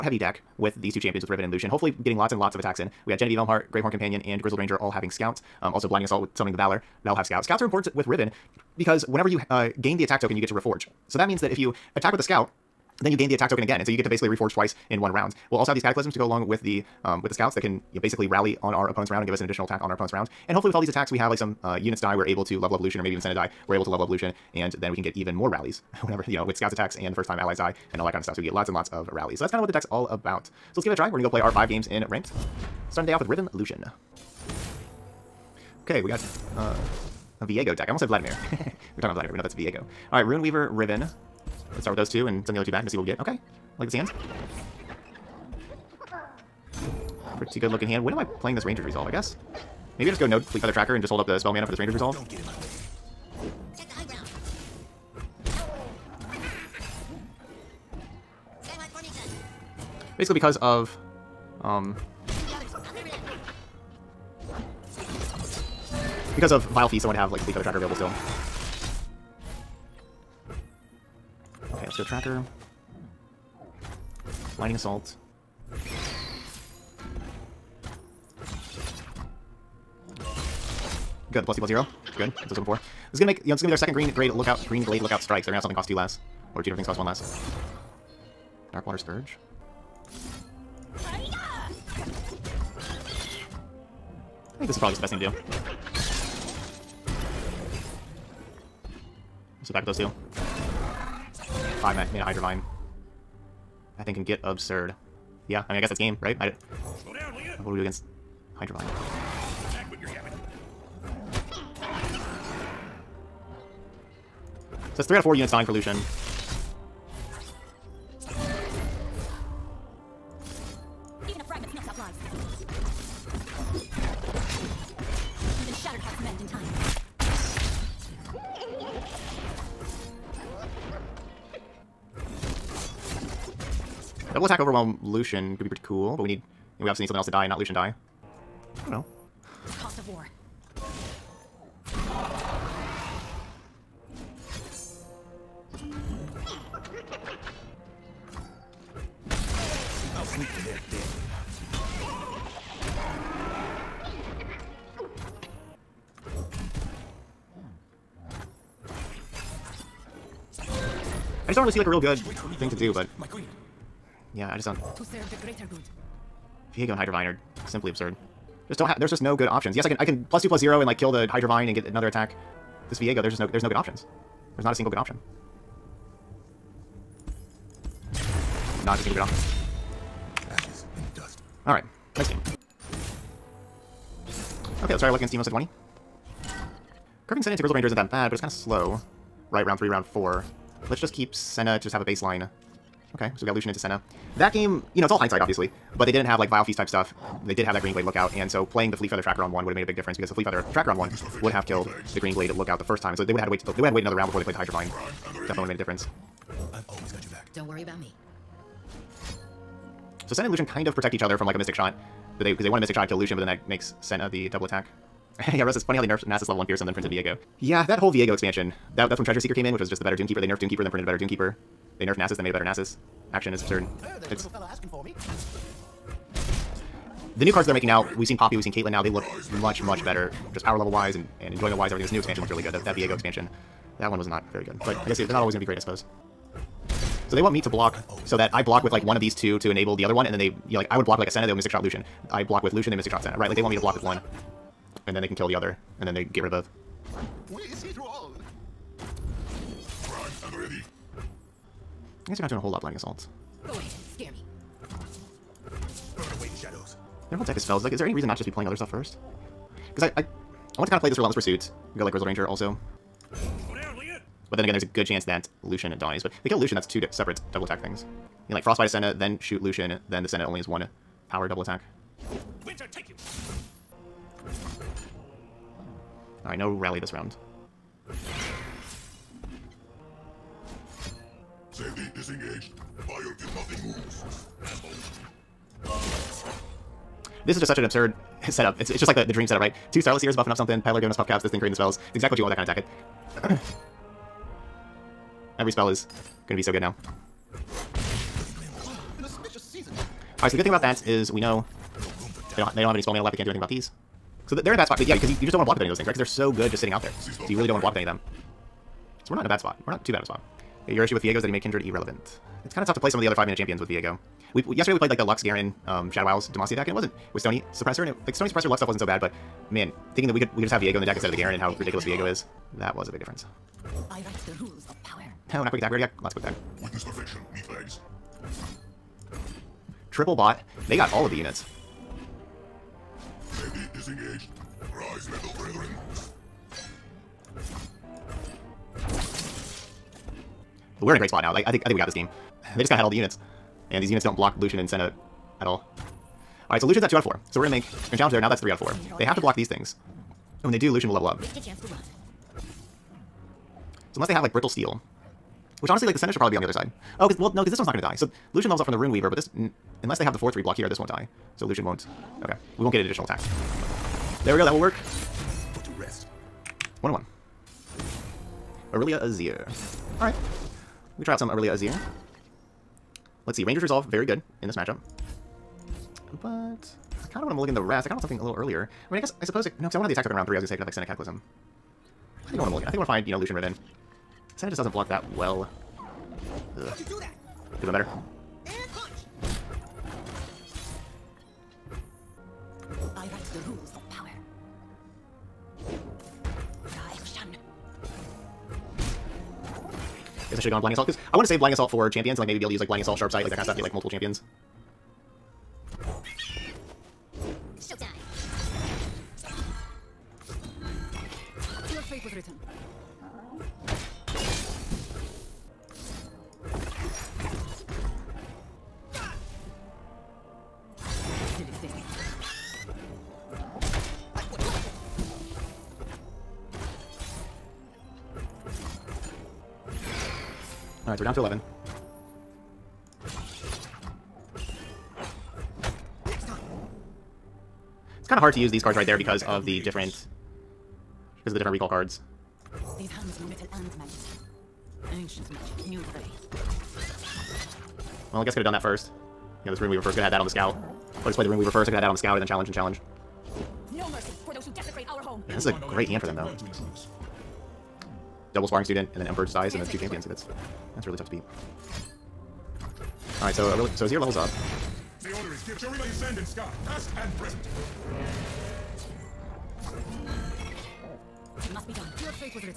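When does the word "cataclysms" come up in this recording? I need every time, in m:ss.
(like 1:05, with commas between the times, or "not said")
0:15, 6:21.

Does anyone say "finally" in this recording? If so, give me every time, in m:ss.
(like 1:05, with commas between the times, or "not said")
not said.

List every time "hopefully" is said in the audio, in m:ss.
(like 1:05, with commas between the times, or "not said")
0:01, 0:20.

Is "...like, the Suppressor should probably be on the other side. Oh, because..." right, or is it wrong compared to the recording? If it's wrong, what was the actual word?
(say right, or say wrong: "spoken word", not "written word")
wrong: "Sentinel", not "Suppressor".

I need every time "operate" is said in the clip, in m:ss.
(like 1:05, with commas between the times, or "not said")
not said.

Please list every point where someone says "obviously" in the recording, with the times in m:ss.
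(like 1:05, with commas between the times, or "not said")
2:16, 3:15.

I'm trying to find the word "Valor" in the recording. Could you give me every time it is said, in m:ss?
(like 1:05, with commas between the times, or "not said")
0:06.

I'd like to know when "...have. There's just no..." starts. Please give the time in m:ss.
2:48.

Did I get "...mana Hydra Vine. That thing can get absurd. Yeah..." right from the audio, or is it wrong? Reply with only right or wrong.
right.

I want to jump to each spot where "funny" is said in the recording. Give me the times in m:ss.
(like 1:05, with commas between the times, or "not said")
3:35.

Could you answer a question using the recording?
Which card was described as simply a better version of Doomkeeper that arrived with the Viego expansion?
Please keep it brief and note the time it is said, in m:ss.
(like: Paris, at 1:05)
Treasure Seeker, at 3:39.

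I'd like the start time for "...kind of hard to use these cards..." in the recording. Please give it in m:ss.
7:18.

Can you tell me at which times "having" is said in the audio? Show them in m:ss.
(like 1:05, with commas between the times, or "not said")
0:04.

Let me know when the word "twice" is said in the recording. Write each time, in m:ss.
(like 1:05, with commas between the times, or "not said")
0:14.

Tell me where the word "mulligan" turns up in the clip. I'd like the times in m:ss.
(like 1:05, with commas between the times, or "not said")
6:17, 6:22.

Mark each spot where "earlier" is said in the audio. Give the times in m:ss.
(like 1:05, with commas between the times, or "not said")
6:18.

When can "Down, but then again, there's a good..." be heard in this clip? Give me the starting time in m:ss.
4:23.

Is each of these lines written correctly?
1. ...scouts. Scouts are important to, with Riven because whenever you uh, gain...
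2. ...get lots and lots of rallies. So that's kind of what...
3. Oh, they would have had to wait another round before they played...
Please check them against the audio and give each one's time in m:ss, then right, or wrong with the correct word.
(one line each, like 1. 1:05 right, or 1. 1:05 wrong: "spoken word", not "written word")
1. 0:07 right
2. 0:28 right
3. 3:23 right.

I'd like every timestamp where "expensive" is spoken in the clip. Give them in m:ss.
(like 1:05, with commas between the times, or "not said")
not said.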